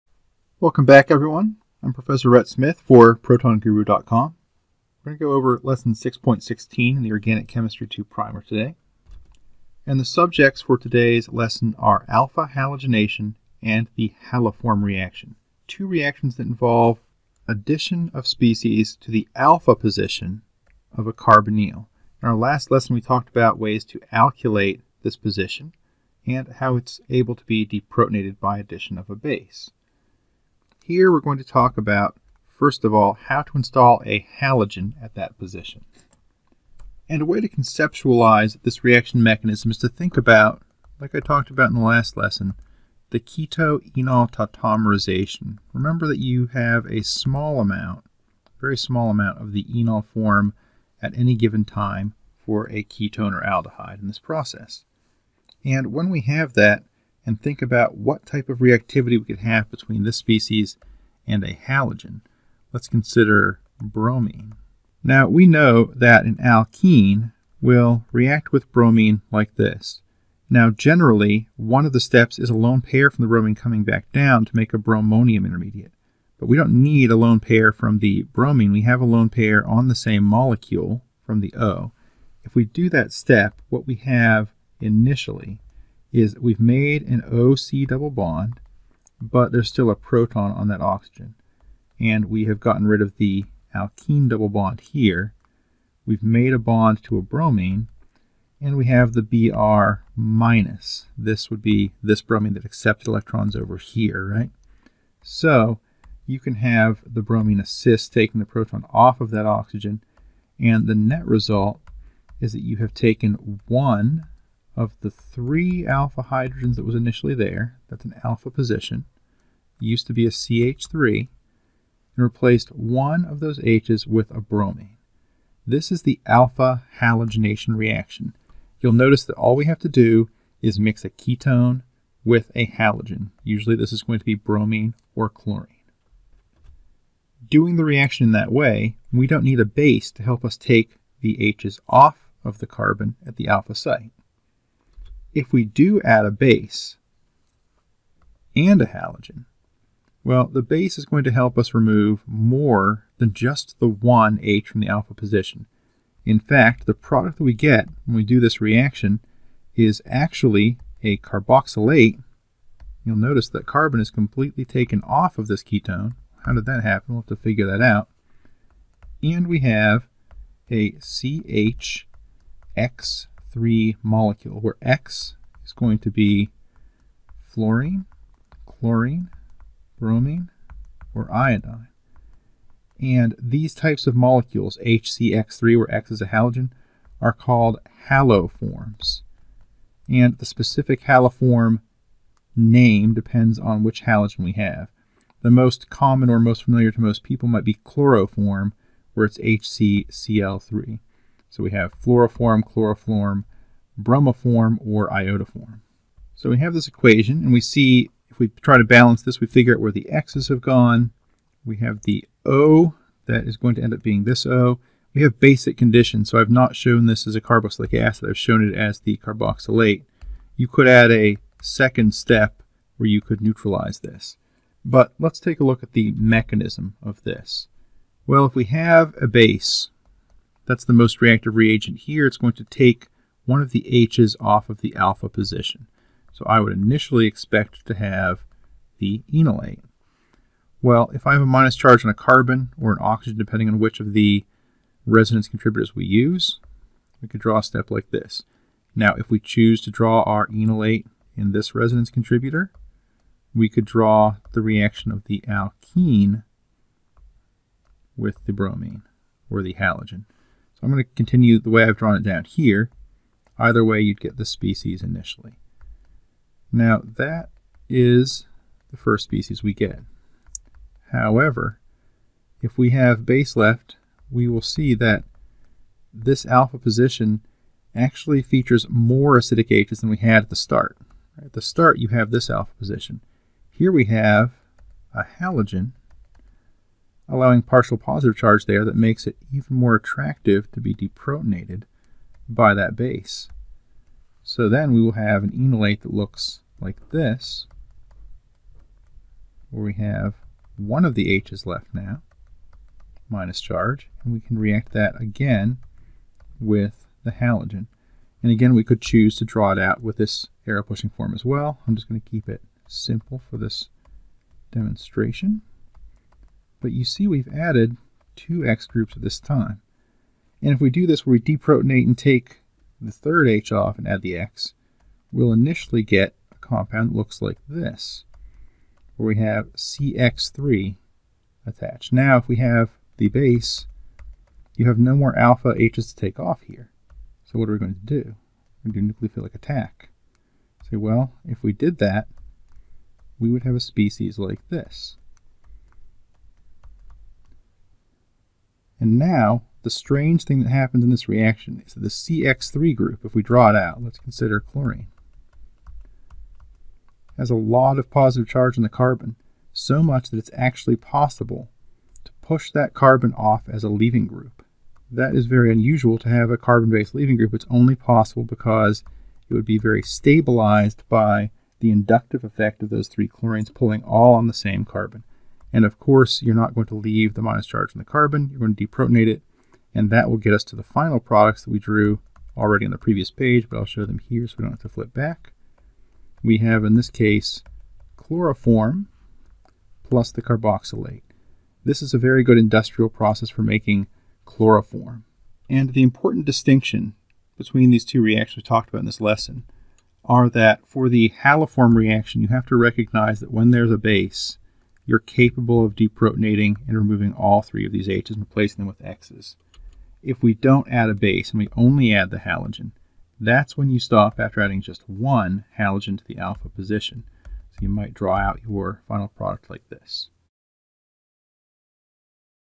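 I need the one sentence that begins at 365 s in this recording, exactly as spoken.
That is very unusual to have a carbon-based leaving group.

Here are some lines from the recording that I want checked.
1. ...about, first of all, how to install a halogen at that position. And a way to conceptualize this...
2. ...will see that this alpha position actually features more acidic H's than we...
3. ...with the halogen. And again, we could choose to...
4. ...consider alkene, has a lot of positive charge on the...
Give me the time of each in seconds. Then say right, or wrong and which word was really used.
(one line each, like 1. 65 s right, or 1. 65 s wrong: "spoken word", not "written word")
1. 31 s right
2. 274 s right
3. 306 s right
4. 354 s wrong: "chlorine", not "alkene".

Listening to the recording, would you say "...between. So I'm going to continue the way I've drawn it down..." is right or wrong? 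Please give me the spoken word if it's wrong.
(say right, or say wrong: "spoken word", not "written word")
wrong: "halogen", not "between".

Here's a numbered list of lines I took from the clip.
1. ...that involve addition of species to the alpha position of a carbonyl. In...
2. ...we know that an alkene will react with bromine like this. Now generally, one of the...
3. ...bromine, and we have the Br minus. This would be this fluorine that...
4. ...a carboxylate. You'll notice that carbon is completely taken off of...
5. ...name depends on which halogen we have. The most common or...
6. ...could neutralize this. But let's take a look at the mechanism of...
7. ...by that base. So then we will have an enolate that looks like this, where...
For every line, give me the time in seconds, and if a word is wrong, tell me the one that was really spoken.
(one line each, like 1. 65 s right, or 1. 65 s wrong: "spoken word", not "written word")
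1. 16 s right
2. 65 s right
3. 97 s wrong: "bromine", not "fluorine"
4. 161 s right
5. 192 s right
6. 223 s right
7. 292 s right.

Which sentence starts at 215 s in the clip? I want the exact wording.
We have basic conditions, so I've not shown this as a carboxylic acid.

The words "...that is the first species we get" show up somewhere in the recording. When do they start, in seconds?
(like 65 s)
267 s.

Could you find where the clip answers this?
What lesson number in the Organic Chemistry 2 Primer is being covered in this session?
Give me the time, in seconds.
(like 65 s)
5 s.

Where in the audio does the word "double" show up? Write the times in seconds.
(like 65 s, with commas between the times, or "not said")
87 s, 94 s.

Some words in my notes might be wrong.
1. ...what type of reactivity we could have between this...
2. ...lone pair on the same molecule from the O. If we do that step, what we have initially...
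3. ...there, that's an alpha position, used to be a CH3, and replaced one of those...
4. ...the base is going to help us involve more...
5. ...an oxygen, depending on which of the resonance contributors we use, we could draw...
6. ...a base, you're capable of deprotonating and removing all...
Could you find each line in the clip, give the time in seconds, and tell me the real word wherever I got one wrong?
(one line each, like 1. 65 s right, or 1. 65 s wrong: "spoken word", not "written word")
1. 57 s right
2. 79 s right
3. 117 s right
4. 150 s wrong: "remove", not "involve"
5. 242 s right
6. 403 s right.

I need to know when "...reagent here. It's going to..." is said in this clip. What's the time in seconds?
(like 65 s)
231 s.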